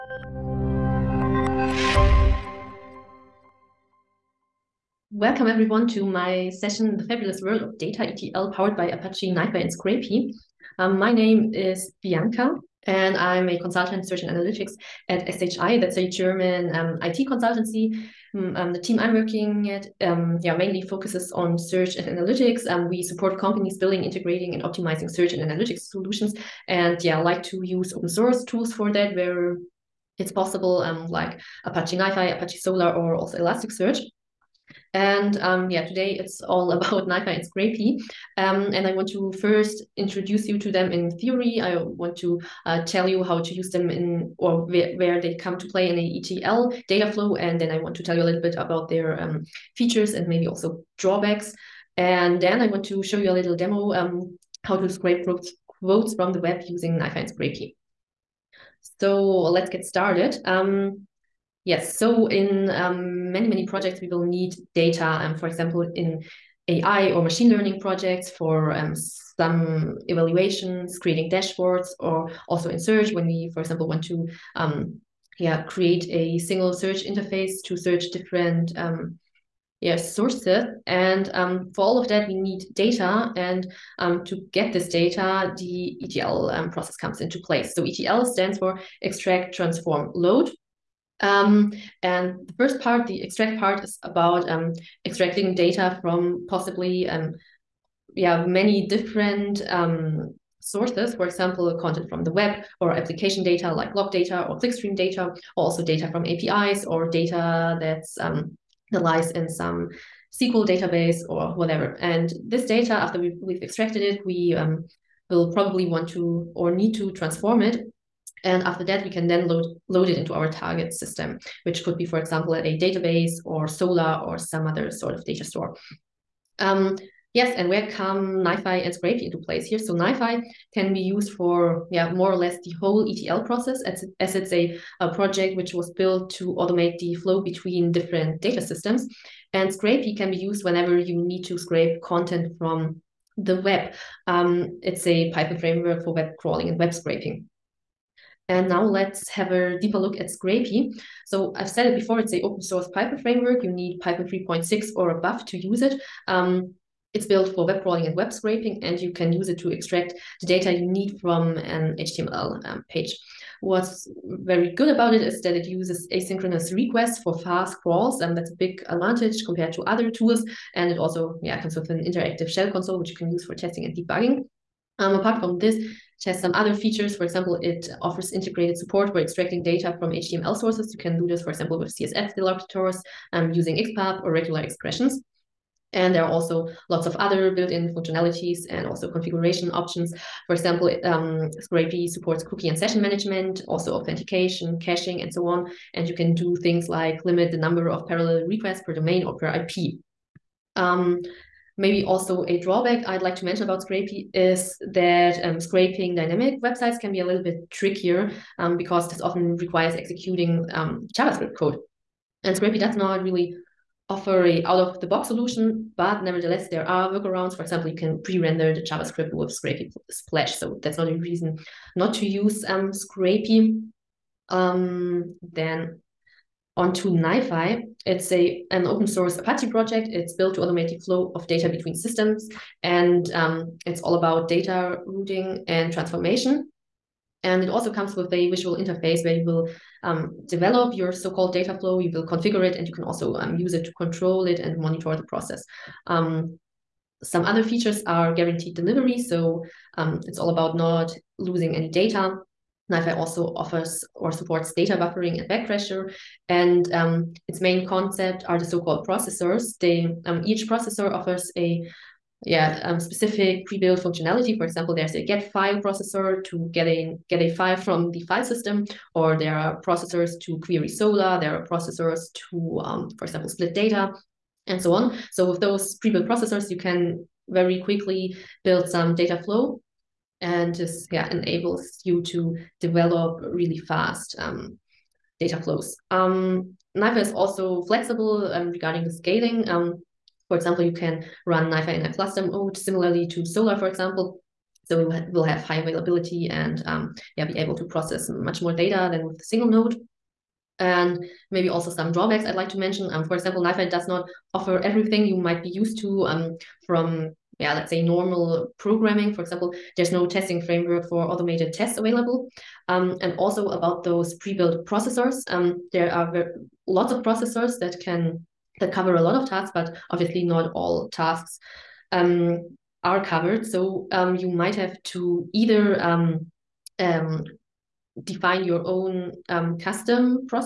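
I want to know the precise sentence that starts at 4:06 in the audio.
Um, some other features are guaranteed delivery.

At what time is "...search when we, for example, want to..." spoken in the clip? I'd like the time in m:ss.
1:12.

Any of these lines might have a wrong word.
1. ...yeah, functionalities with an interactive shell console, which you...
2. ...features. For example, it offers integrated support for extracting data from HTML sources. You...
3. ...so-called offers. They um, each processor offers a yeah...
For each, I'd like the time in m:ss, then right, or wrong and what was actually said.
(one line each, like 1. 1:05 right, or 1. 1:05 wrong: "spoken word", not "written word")
1. 2:51 wrong: "comes", not "functionalities"
2. 2:56 right
3. 4:18 wrong: "processors", not "offers".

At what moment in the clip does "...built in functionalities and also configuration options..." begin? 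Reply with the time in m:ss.
3:07.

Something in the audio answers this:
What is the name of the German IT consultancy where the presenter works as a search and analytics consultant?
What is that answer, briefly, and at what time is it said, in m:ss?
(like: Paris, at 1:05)
SHI, at 0:15.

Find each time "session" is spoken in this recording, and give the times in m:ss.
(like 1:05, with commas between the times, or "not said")
0:06, 3:12.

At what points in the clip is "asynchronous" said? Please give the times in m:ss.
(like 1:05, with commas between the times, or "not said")
2:46.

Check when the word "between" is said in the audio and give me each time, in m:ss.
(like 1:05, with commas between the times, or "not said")
2:17, 3:51.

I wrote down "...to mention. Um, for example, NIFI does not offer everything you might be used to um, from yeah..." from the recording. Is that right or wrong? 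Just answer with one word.
right.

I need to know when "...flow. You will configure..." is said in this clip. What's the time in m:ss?
4:01.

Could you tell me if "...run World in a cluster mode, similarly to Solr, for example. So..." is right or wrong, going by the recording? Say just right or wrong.
wrong.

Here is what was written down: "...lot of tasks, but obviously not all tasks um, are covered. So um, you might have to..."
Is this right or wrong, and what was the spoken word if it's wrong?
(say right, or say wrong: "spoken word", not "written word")
right.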